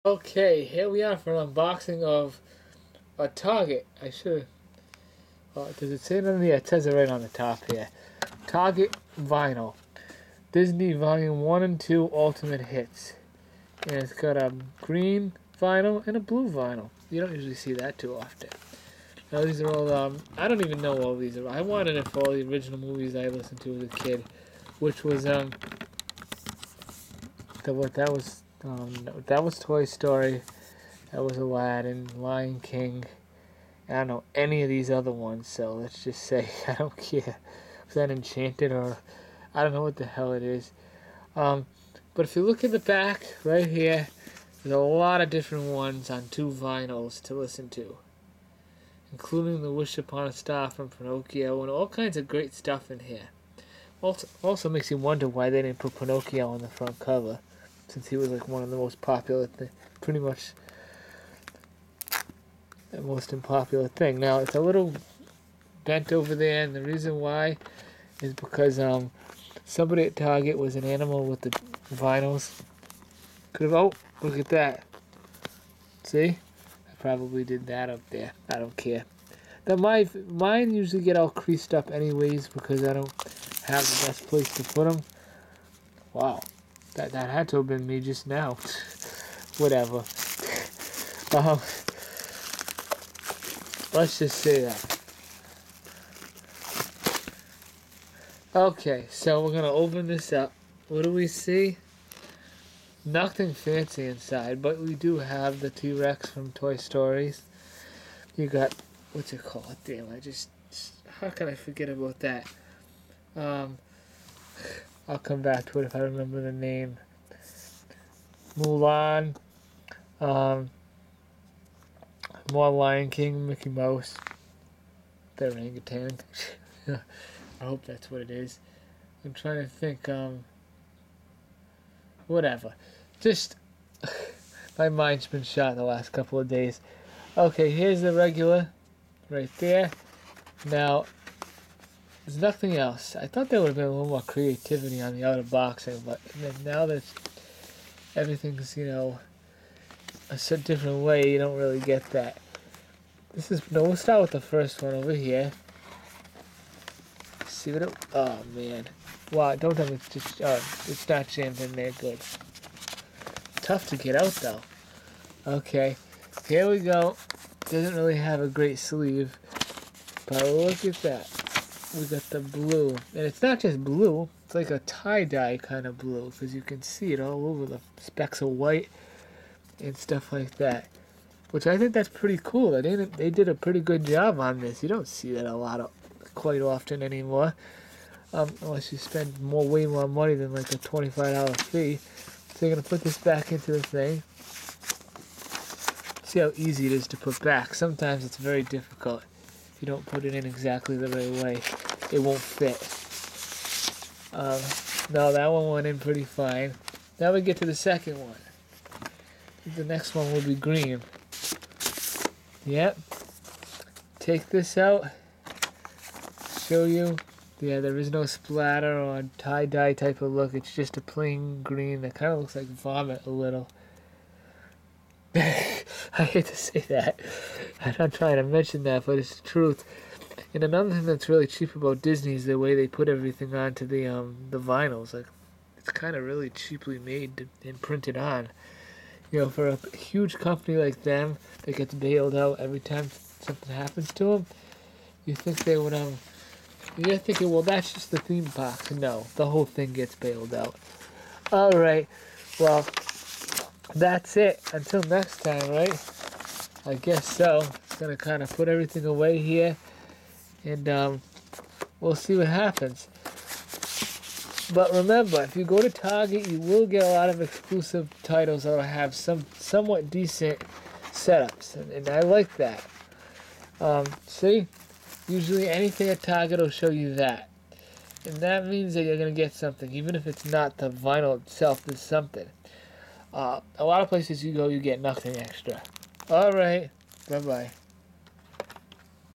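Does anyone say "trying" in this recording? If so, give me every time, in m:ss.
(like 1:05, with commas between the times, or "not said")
2:09, 3:48.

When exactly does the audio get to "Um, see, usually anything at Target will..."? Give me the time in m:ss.
4:33.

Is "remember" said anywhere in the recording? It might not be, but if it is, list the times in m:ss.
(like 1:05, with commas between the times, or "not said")
1:55, 4:24.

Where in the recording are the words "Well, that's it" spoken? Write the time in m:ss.
4:12.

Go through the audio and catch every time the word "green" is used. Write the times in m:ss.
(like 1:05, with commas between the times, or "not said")
0:14, 3:30, 3:41.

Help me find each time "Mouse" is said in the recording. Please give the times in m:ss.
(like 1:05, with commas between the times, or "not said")
2:03.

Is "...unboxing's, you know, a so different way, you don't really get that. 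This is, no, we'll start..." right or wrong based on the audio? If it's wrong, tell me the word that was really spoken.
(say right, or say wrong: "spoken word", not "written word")
wrong: "everything", not "unboxing".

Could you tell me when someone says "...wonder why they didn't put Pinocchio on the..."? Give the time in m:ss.
0:54.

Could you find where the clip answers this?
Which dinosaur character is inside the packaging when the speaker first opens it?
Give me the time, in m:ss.
1:45.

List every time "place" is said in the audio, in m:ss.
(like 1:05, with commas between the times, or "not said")
1:24, 4:44.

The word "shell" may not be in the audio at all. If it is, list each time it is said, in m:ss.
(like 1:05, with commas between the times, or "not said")
not said.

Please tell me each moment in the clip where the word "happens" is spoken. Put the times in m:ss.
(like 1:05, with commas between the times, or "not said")
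4:03, 4:22.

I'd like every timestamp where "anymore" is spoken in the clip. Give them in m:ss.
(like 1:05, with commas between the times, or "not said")
3:07.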